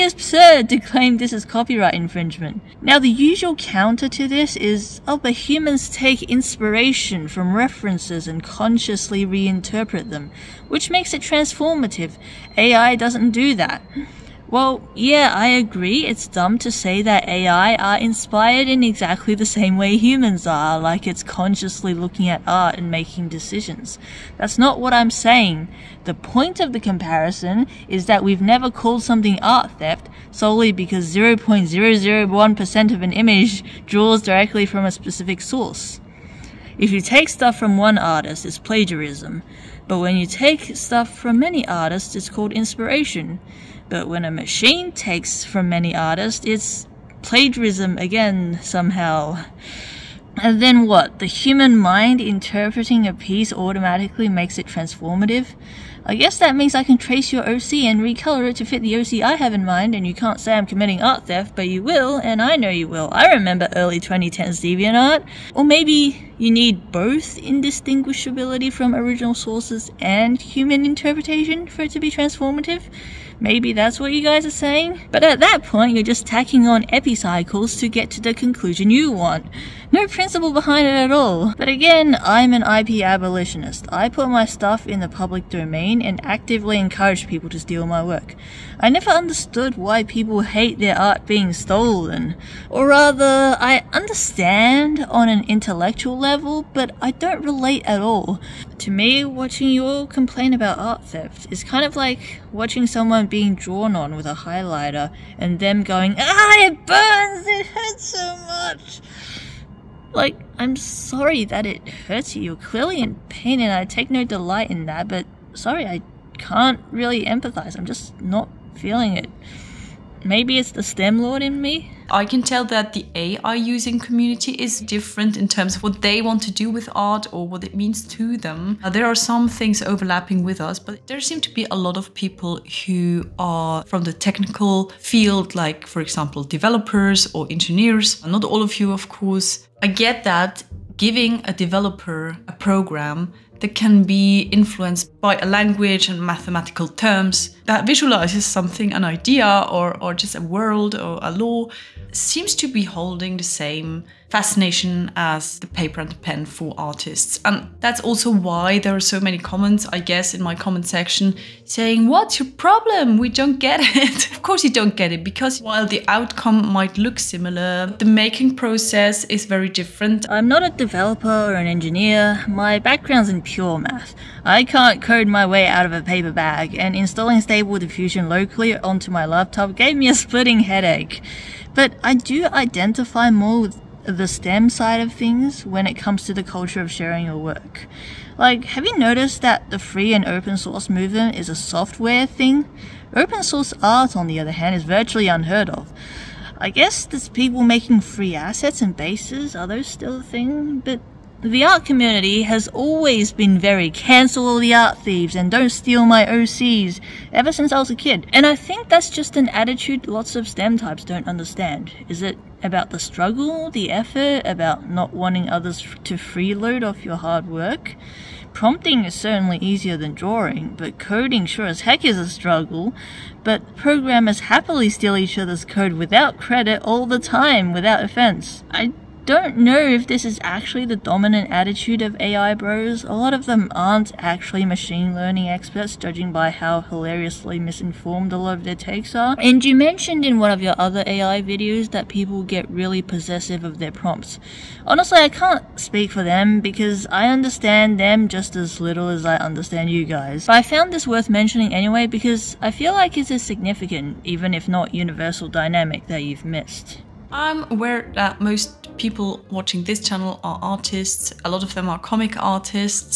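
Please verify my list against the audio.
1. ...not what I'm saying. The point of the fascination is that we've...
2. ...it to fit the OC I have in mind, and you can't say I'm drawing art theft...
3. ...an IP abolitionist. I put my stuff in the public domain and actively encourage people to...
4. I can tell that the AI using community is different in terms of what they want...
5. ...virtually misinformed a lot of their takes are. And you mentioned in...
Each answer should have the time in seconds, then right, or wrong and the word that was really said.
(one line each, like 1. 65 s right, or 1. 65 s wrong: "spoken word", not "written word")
1. 24 s wrong: "comparison", not "fascination"
2. 58 s wrong: "committing", not "drawing"
3. 82 s right
4. 122 s right
5. 236 s wrong: "hilariously", not "virtually".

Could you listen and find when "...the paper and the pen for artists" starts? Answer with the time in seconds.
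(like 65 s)
155 s.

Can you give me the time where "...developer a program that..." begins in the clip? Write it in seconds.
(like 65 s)
141 s.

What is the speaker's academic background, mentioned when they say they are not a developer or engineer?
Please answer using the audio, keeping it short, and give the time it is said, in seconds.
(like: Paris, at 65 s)
Pure math, at 173 s.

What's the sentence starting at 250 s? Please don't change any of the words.
But I found this worth mentioning anyway because I feel like it's a significant, even if not universal, dynamic that you've missed.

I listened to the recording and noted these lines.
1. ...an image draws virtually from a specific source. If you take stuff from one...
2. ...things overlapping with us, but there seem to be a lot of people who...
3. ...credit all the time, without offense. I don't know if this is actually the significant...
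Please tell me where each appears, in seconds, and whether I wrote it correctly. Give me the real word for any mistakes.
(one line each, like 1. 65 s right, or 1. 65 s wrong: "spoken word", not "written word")
1. 33 s wrong: "directly", not "virtually"
2. 129 s right
3. 226 s wrong: "dominant", not "significant".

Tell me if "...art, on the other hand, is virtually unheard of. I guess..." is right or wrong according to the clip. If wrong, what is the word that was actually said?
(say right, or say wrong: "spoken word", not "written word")
right.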